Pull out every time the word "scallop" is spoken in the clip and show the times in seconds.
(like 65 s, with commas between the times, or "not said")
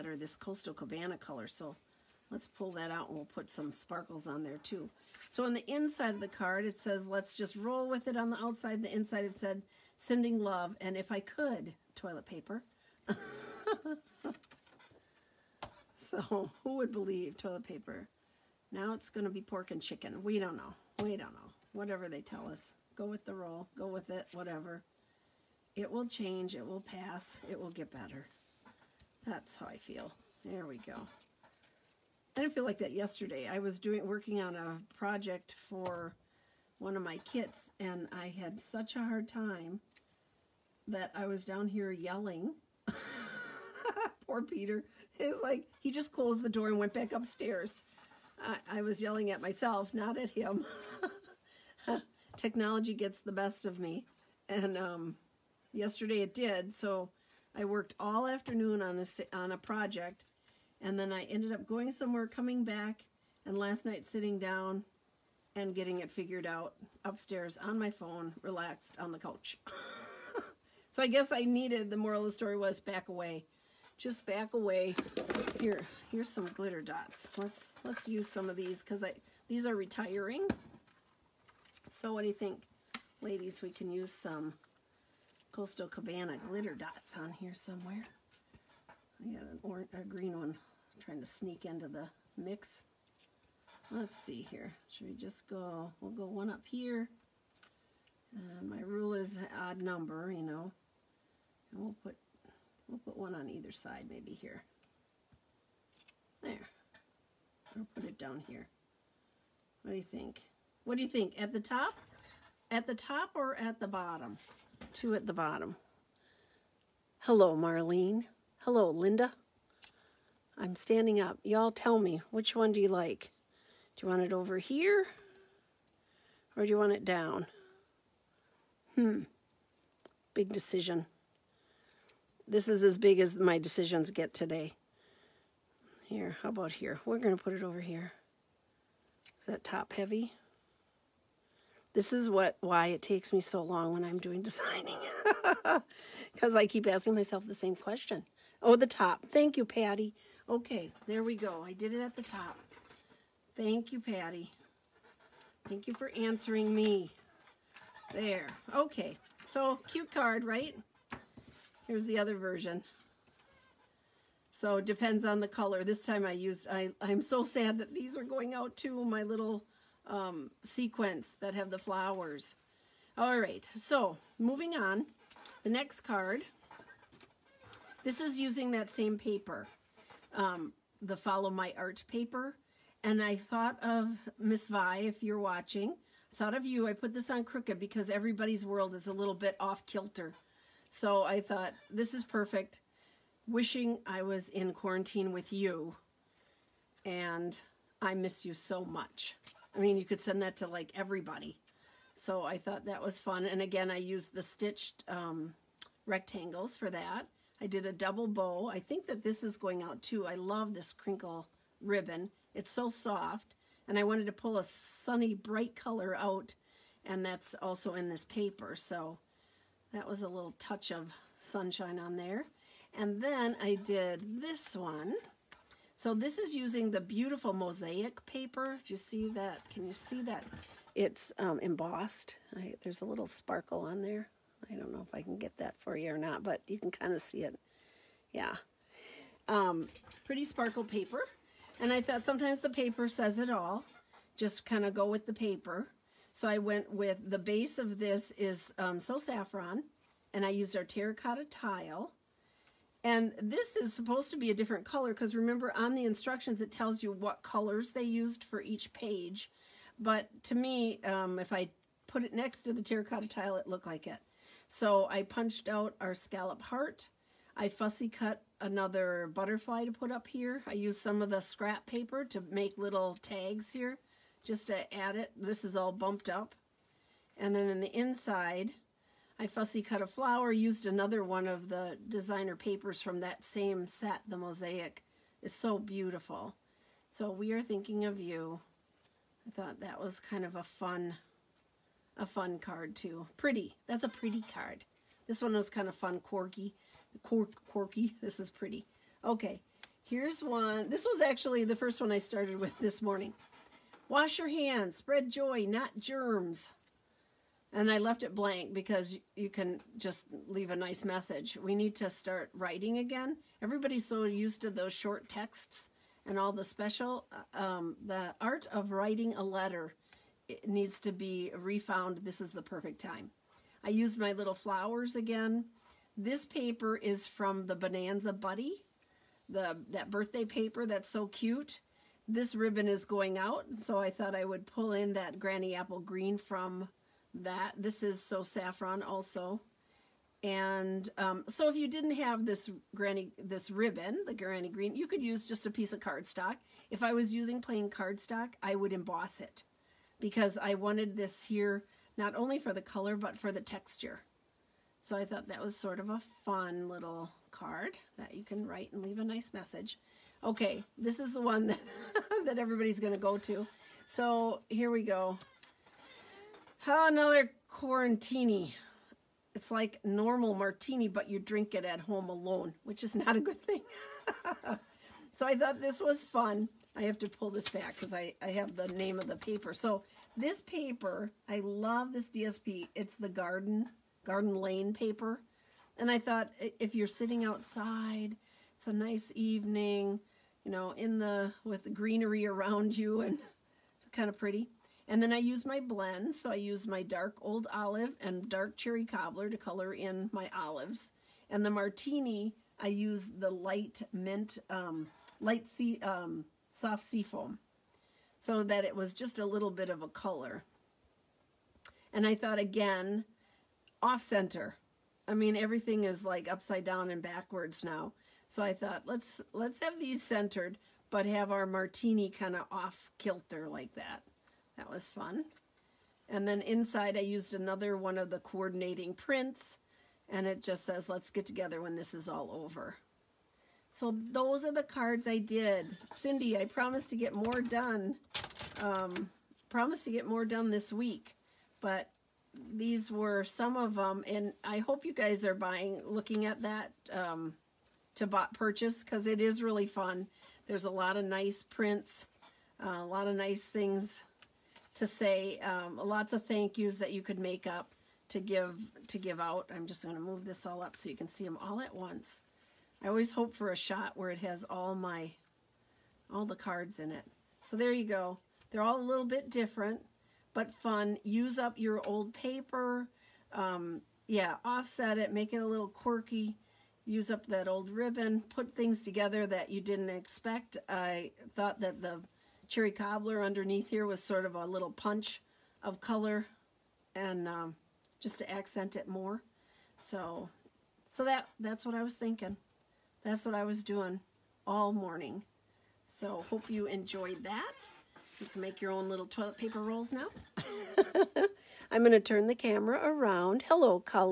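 266 s.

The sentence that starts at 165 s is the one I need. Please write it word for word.
This time I used, I, I'm so sad that these are going out too, my little um, sequence that have the flowers.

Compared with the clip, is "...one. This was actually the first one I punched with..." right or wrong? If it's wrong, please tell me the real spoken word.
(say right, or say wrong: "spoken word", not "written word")
wrong: "started", not "punched".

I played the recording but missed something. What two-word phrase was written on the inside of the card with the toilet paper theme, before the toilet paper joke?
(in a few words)
Sending love.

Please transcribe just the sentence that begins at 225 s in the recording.
So this is using the beautiful mosaic paper.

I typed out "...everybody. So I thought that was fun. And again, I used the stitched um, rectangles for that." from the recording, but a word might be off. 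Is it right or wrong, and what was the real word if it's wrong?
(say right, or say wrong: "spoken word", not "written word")
right.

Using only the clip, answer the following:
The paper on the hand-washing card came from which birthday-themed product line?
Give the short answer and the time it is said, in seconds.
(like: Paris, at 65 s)
Bonanza Buddy, at 327 s.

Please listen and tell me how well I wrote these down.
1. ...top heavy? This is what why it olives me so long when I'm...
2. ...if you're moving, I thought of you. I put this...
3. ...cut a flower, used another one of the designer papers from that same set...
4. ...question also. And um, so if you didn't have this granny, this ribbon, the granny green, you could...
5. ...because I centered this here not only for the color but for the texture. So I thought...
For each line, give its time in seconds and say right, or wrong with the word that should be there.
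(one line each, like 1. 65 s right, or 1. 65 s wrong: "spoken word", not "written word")
1. 139 s wrong: "takes", not "olives"
2. 184 s wrong: "watching", not "moving"
3. 279 s right
4. 338 s wrong: "saffron", not "question"
5. 350 s wrong: "wanted", not "centered".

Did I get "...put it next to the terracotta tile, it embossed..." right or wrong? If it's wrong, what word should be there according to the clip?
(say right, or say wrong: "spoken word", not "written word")
wrong: "looked", not "embossed".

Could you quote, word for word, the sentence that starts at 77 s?
Let's let's use some of these because I these are retiring.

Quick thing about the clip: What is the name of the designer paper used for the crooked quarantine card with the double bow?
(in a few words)
Follow My Art.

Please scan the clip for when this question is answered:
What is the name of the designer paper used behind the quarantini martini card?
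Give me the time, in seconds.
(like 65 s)
384 s.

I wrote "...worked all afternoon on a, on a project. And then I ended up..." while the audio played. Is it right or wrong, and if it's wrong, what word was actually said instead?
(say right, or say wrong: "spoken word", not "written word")
right.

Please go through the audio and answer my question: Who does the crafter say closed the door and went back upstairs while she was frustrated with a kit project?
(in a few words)
Peter.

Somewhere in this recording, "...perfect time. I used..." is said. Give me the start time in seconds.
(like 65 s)
322 s.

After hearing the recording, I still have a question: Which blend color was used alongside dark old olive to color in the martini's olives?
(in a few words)
Dark Cherry Cobbler.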